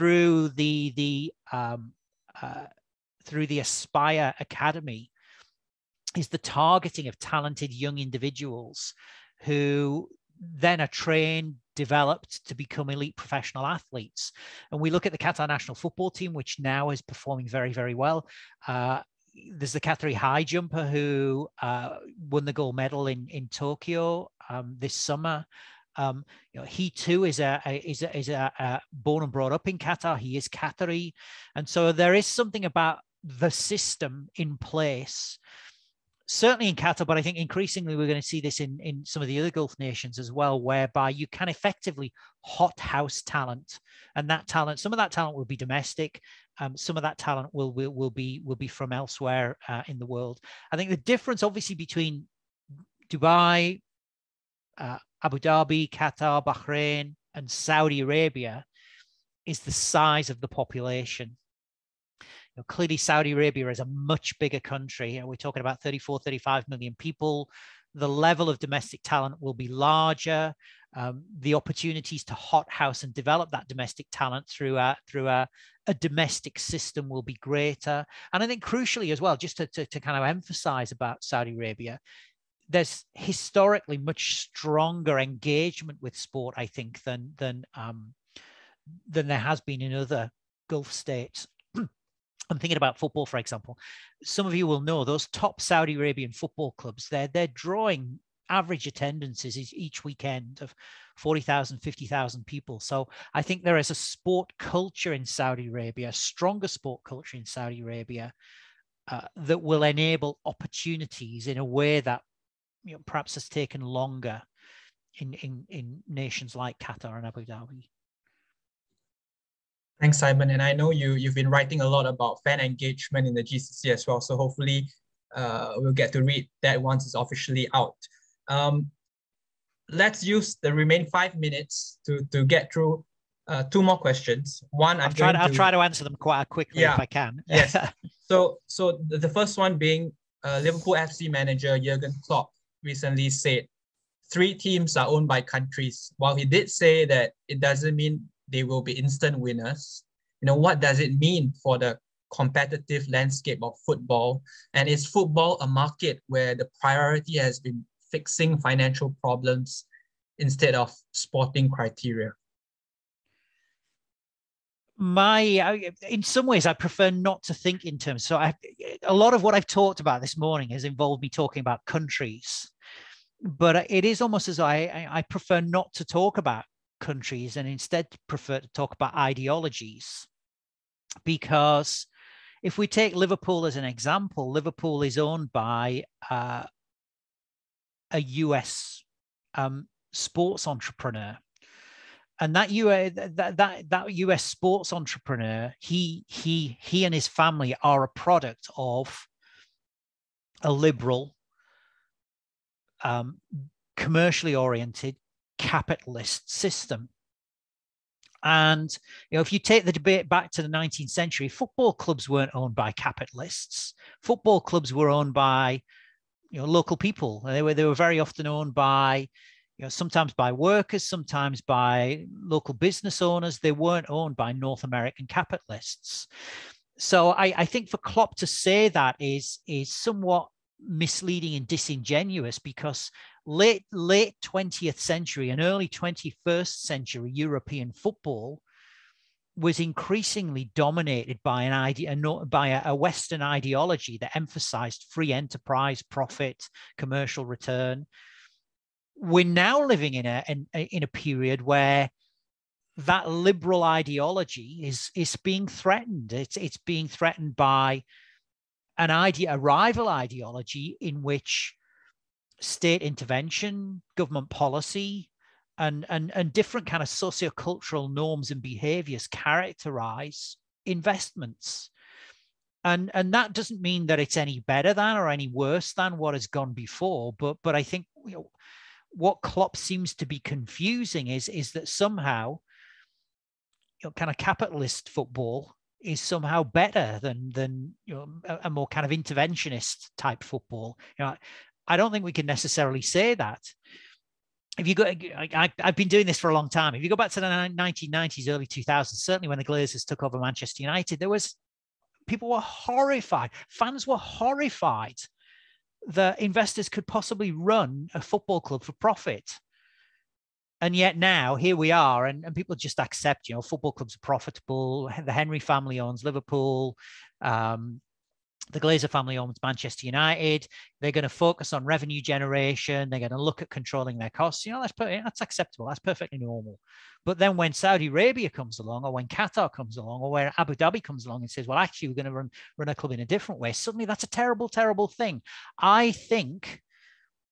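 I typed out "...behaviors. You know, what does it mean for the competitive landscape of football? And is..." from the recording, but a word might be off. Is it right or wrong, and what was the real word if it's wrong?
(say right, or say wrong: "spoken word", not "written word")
wrong: "winners", not "behaviors".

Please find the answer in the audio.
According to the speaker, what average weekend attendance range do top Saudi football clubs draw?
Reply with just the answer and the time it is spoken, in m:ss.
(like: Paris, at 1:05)
40,000 to 50,000, at 1:41.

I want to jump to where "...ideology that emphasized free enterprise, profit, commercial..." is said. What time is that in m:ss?
4:03.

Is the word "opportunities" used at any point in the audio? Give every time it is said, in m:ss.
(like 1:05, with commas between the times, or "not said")
1:11, 1:50.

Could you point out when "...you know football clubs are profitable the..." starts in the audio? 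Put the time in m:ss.
5:13.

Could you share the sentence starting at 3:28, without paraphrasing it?
And you know, if you take the debate back to the 19th century, football clubs weren't owned by capitalists.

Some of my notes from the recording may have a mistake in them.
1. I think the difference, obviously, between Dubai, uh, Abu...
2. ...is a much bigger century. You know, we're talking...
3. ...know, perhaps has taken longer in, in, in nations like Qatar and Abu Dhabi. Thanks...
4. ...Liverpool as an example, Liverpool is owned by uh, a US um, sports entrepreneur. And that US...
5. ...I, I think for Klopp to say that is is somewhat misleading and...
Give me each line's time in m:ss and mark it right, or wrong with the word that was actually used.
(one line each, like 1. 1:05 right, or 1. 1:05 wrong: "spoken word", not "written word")
1. 0:50 right
2. 1:03 wrong: "country", not "century"
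3. 1:52 right
4. 3:03 right
5. 3:47 right.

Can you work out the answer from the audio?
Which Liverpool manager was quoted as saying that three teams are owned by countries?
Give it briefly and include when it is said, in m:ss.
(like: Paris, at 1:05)
Jurgen Klopp, at 2:21.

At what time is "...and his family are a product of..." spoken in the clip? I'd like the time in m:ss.
3:17.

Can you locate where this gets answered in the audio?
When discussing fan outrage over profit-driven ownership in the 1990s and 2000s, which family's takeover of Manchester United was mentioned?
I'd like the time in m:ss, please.
4:59.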